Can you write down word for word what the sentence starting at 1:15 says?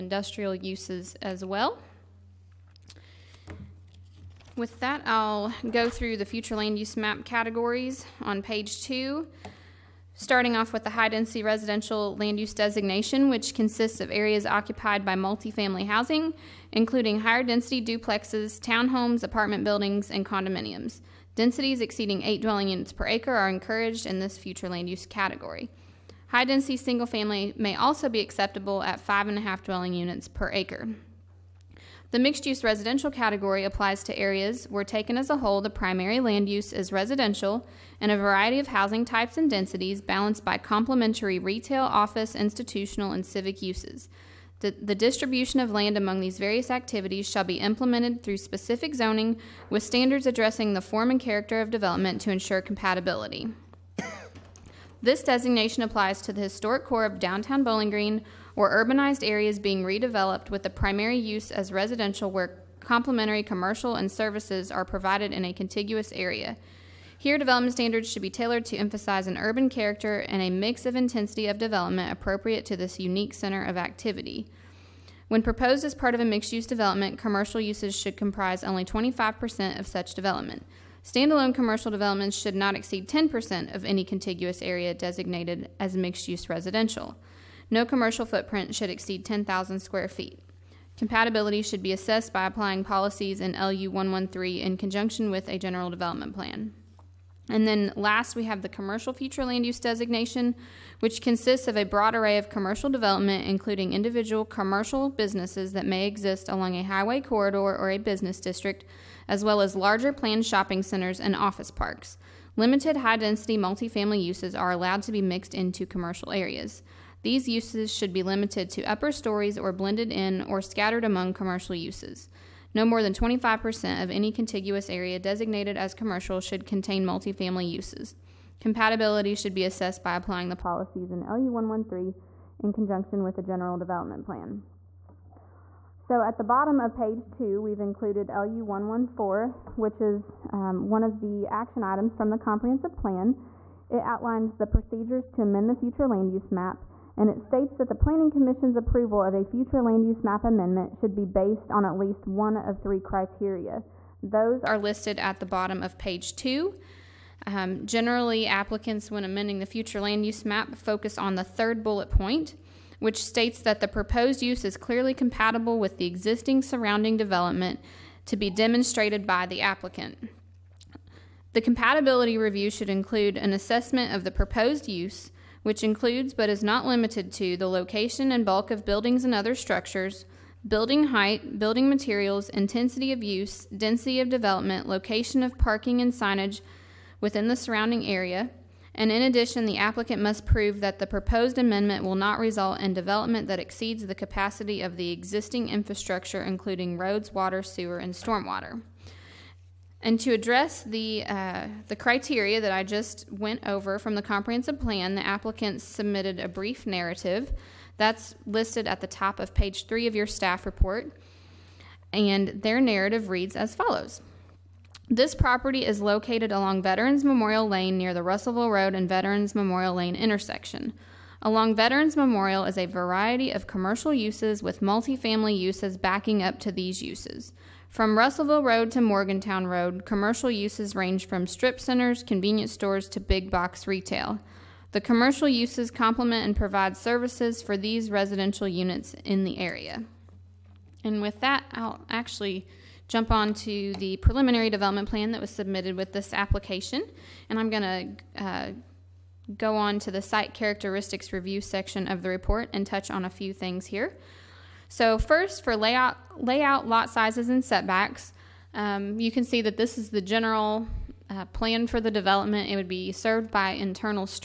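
When proposed as part of a mixed use development, commercial uses should comprise only 25% of such development.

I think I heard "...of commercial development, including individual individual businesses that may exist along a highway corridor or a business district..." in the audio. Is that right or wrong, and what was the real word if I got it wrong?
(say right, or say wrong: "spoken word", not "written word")
wrong: "commercial", not "individual".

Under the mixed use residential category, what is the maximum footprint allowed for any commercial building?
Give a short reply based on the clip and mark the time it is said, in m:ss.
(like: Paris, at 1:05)
10,000 square feet, at 1:29.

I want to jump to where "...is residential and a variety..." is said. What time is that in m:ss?
0:36.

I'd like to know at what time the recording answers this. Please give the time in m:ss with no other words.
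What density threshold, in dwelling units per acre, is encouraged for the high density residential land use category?
0:22.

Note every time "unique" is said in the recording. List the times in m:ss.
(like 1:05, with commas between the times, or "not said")
1:12.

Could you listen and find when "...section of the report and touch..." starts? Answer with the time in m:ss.
4:11.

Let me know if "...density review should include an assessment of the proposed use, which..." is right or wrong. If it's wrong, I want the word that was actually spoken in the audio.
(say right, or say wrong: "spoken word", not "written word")
wrong: "compatibility", not "density".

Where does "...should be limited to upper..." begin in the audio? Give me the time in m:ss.
1:57.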